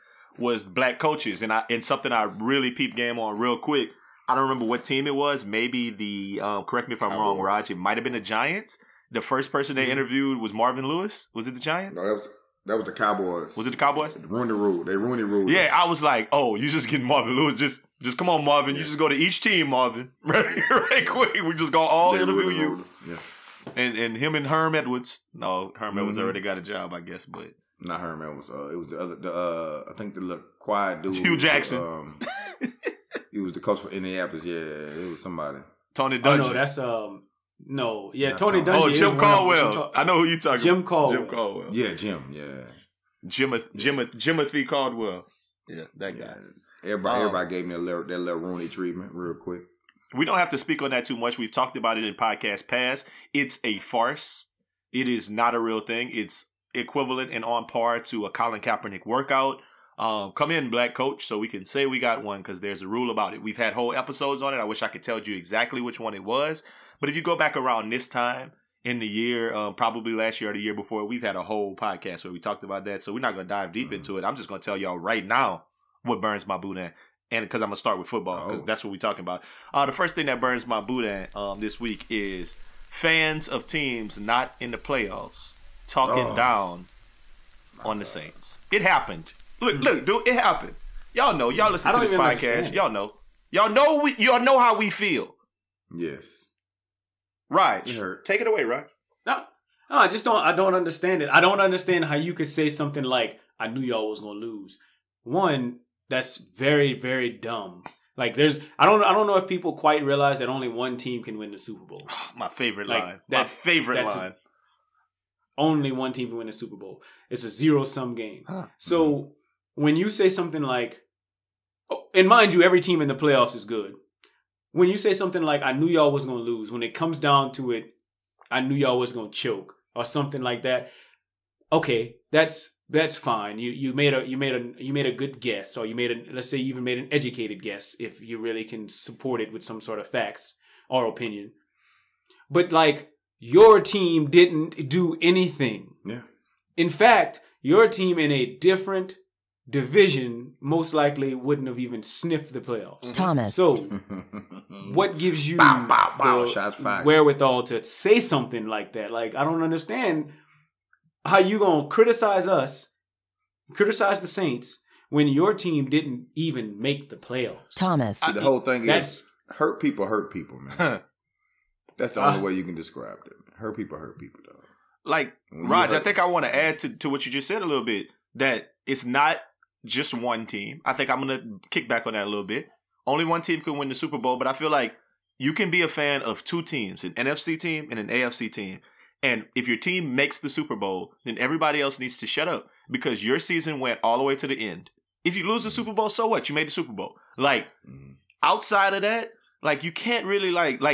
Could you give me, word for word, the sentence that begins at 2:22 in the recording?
But like your team didn't do anything.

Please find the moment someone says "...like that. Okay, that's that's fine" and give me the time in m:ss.
2:10.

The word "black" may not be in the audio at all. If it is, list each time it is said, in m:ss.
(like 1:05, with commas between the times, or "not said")
0:00, 1:00.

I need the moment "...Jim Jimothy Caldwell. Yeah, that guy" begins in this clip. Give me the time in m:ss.
0:43.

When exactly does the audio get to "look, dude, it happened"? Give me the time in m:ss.
1:29.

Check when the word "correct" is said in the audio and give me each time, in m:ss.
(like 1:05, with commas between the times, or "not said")
0:06.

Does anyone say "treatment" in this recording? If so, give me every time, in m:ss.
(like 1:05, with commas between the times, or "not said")
0:48.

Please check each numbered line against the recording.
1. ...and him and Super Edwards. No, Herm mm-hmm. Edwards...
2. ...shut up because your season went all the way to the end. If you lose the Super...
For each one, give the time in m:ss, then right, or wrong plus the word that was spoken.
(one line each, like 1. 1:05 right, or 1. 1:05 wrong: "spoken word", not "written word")
1. 0:23 wrong: "Herm", not "Super"
2. 3:12 right.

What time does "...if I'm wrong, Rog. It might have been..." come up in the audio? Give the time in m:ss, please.
0:06.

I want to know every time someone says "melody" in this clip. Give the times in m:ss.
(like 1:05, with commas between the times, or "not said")
not said.